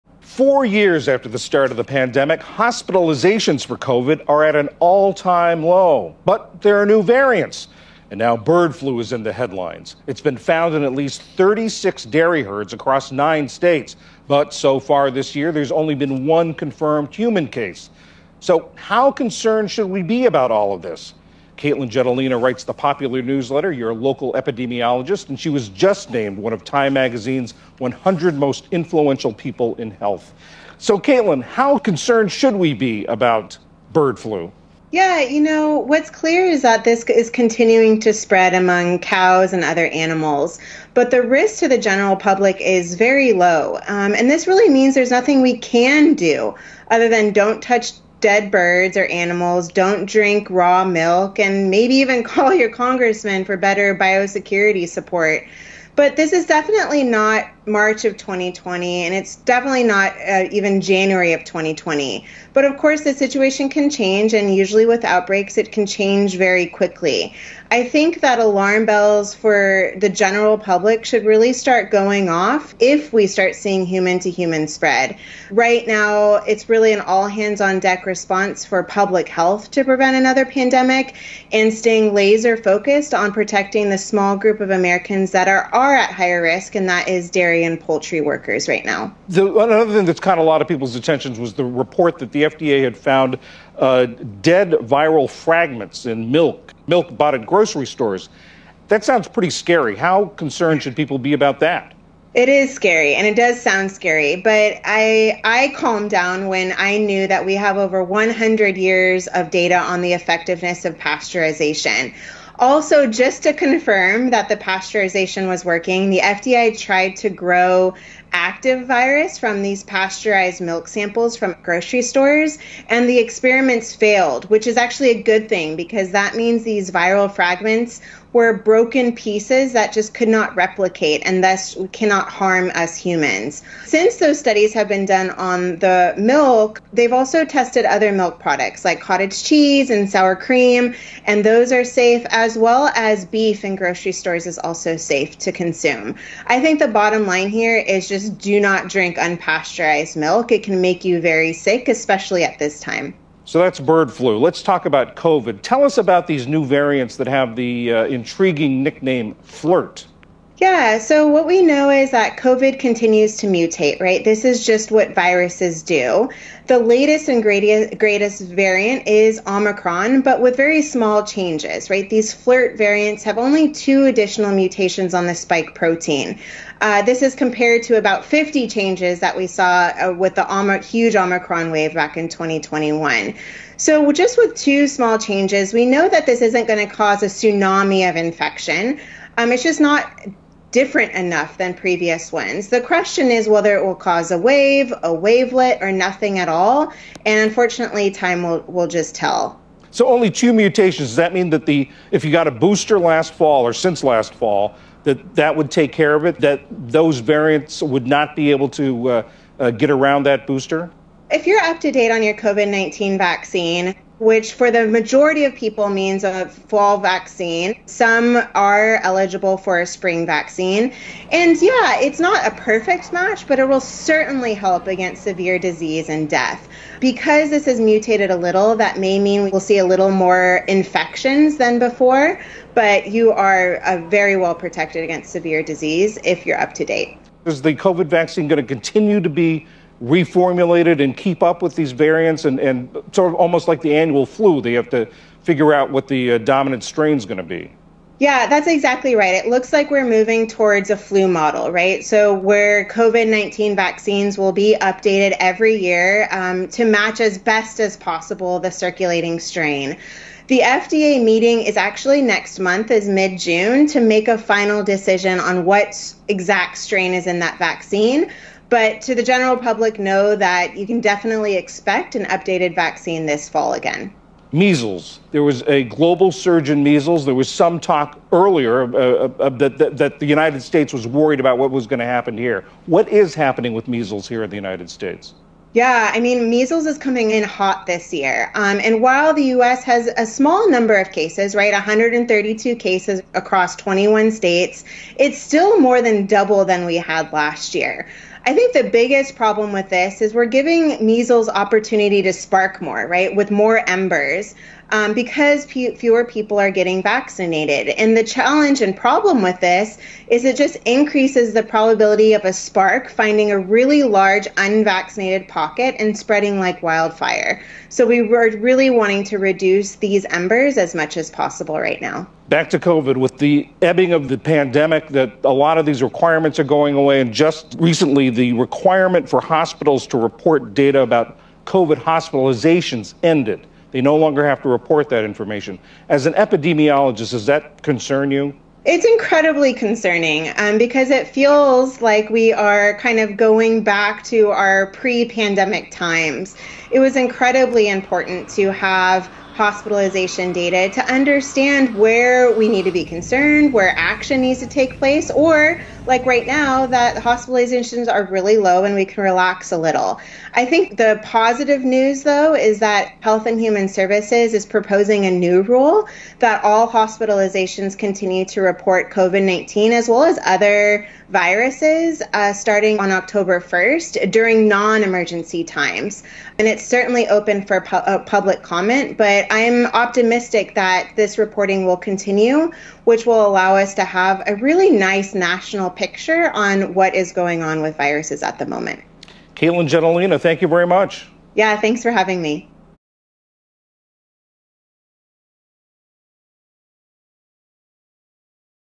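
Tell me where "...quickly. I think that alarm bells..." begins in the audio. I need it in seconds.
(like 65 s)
66 s.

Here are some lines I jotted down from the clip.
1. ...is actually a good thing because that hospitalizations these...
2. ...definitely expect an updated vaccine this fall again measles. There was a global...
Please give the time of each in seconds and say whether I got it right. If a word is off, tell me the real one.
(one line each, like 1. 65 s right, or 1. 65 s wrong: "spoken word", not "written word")
1. 124 s wrong: "means", not "hospitalizations"
2. 271 s right.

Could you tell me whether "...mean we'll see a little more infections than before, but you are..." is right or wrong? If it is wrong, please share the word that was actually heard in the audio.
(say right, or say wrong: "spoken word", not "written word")
right.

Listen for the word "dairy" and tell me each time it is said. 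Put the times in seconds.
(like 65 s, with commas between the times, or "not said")
12 s, 87 s.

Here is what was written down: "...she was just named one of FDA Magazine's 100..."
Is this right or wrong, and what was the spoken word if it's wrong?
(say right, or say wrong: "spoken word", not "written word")
wrong: "Time", not "FDA".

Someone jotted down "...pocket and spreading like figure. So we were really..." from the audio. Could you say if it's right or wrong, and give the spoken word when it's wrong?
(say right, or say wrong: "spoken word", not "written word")
wrong: "wildfire", not "figure".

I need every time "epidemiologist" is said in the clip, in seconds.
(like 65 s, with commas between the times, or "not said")
24 s, 336 s.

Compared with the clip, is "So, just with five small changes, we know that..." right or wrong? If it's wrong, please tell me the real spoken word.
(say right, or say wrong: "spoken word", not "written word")
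wrong: "two", not "five".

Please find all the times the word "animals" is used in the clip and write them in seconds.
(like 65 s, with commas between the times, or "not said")
39 s, 49 s.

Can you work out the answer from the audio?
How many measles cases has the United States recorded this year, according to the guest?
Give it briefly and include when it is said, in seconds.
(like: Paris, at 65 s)
132, at 291 s.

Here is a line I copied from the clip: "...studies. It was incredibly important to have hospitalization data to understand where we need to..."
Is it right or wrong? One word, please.
wrong.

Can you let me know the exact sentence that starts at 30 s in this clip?
So, Katelyn, how concerned should we be about bird flu?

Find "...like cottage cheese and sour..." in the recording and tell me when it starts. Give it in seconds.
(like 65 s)
138 s.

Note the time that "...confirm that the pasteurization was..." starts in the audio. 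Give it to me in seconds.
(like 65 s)
113 s.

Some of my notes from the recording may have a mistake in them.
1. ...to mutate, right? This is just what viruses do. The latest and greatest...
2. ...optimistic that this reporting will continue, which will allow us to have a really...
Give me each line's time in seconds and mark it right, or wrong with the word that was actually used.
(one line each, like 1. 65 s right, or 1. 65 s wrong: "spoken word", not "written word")
1. 163 s right
2. 379 s right.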